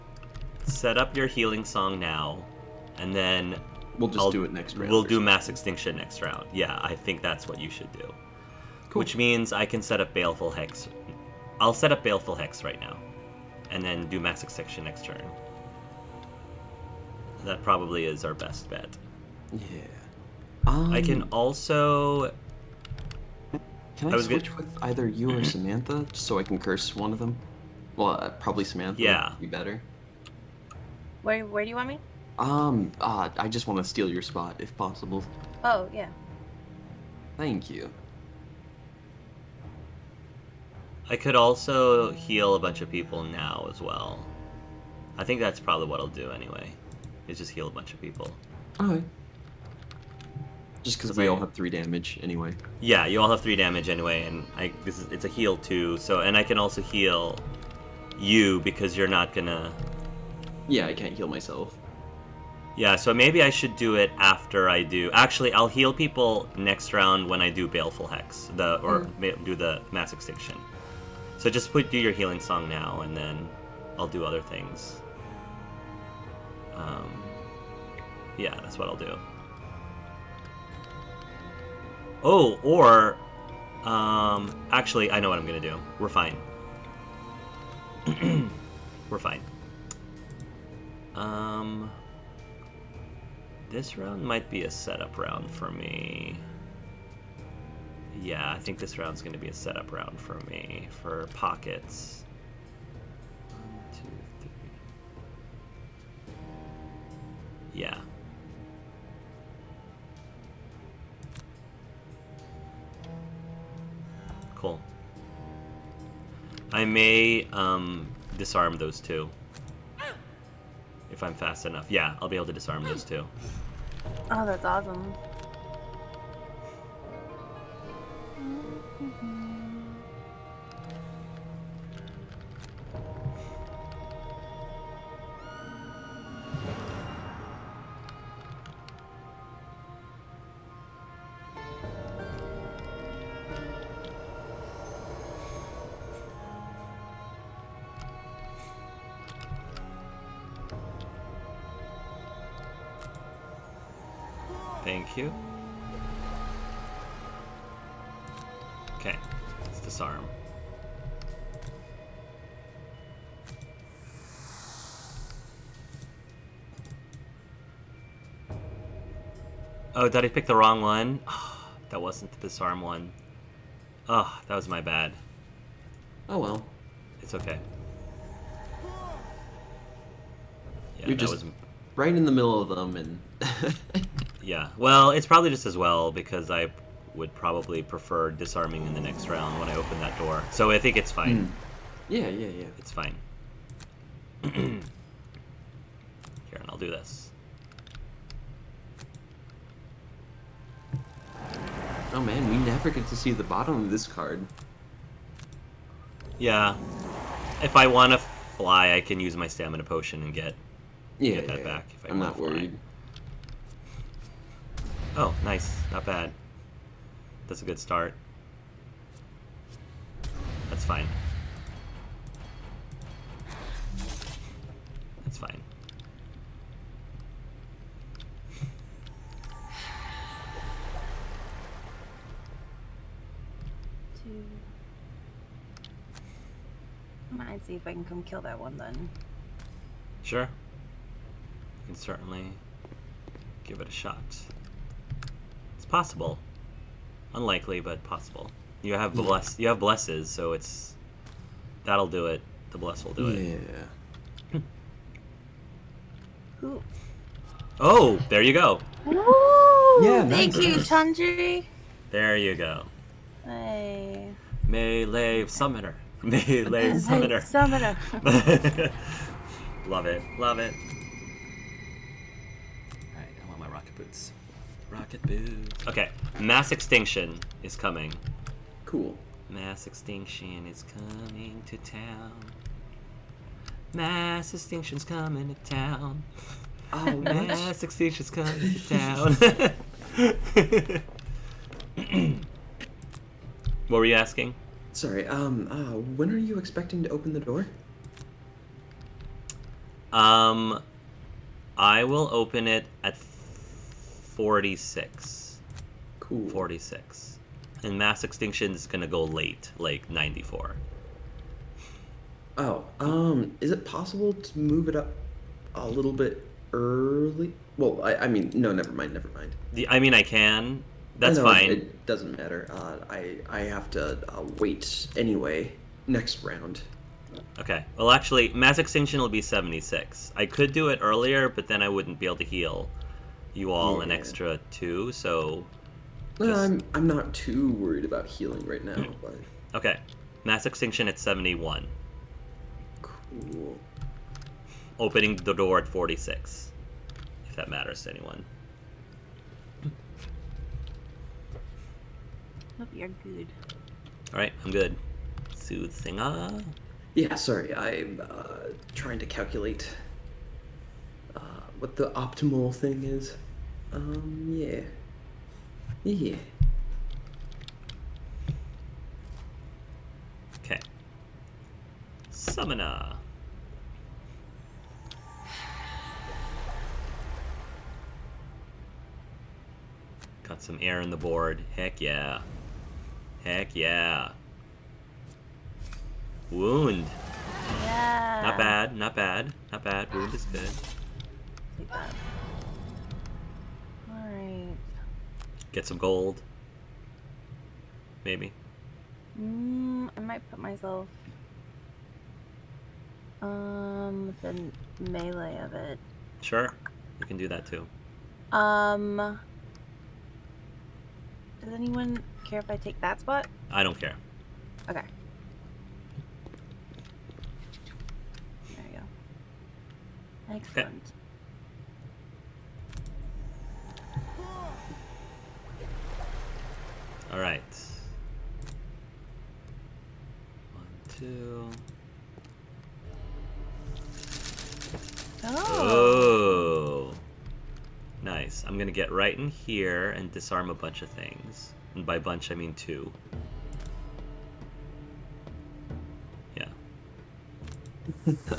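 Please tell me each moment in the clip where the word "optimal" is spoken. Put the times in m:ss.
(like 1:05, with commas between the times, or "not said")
6:02.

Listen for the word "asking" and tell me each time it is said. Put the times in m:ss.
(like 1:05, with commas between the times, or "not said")
4:54.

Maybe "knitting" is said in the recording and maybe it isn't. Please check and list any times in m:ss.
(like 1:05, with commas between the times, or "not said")
not said.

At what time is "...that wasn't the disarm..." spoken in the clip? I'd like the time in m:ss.
2:51.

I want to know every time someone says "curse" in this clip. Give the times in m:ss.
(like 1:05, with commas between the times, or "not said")
0:26.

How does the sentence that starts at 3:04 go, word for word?
Well, it's probably just as well because I would probably prefer disarming in the next round when I open that door.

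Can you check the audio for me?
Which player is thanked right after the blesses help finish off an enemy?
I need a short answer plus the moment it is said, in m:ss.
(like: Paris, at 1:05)
Chandri, at 4:20.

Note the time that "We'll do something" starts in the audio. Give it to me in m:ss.
0:04.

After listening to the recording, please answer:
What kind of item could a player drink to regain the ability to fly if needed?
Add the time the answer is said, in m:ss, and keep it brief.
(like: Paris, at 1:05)
stamina potion, at 3:29.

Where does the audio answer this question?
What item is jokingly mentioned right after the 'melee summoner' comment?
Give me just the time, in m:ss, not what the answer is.
4:35.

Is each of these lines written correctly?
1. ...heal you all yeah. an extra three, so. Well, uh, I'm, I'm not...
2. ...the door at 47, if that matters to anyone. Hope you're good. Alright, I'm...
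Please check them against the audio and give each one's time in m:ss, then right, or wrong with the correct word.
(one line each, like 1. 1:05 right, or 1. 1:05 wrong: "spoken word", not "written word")
1. 5:32 wrong: "two", not "three"
2. 5:45 wrong: "46", not "47".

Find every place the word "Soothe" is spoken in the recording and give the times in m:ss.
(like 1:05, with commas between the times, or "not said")
5:55.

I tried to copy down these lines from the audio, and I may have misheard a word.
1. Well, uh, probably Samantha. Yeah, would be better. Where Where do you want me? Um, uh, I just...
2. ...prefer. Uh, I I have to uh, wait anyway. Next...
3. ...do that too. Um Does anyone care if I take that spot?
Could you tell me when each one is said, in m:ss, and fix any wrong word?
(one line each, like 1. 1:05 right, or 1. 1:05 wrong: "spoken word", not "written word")
1. 0:27 right
2. 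5:22 wrong: "matter", not "prefer"
3. 6:47 right.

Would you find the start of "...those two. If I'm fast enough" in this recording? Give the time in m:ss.
1:58.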